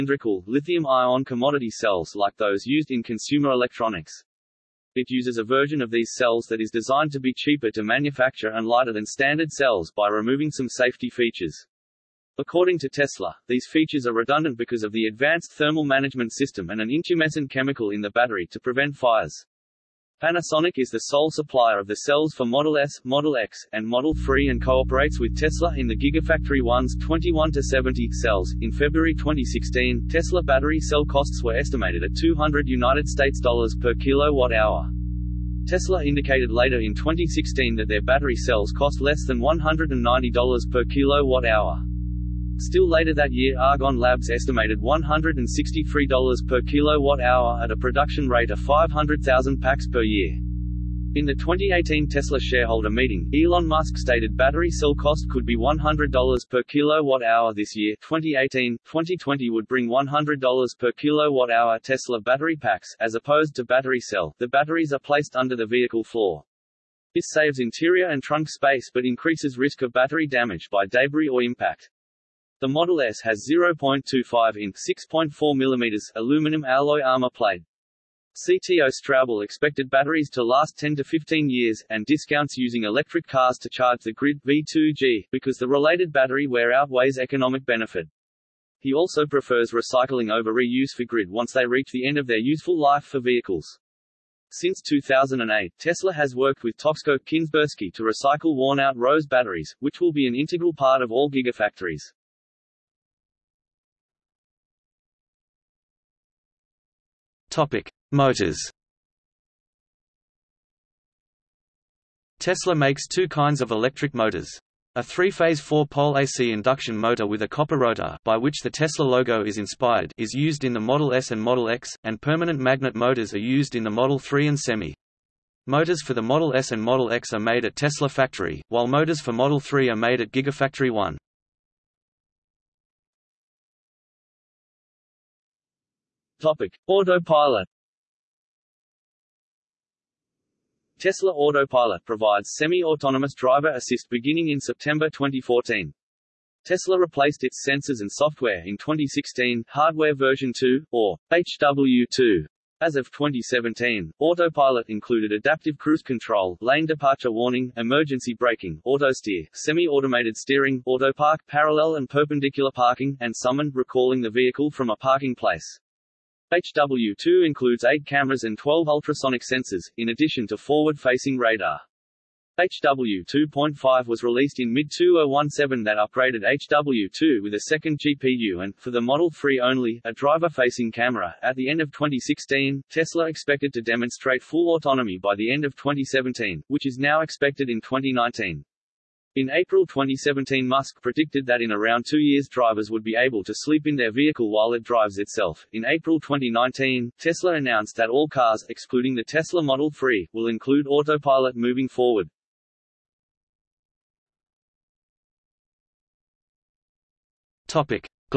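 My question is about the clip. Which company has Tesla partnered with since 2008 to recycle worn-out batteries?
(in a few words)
Toxco Kinsbursky.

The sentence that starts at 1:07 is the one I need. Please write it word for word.
This saves interior and trunk space but increases risk of battery damage by debris or impact.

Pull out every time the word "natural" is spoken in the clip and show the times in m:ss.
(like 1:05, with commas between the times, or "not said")
not said.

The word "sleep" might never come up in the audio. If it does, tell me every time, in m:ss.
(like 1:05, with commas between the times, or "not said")
3:13.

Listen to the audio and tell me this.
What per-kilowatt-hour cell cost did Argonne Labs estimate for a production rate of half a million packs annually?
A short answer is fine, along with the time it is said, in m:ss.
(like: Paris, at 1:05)
$163, at 0:44.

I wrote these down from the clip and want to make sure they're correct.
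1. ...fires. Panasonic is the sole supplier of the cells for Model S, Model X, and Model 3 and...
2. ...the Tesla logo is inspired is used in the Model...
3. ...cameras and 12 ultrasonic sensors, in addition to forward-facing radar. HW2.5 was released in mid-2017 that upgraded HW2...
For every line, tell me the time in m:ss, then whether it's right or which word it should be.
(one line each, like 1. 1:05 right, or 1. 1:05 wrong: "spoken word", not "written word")
1. 0:18 right
2. 1:58 right
3. 2:48 right.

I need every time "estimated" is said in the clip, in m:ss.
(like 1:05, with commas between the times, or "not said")
0:31, 0:44.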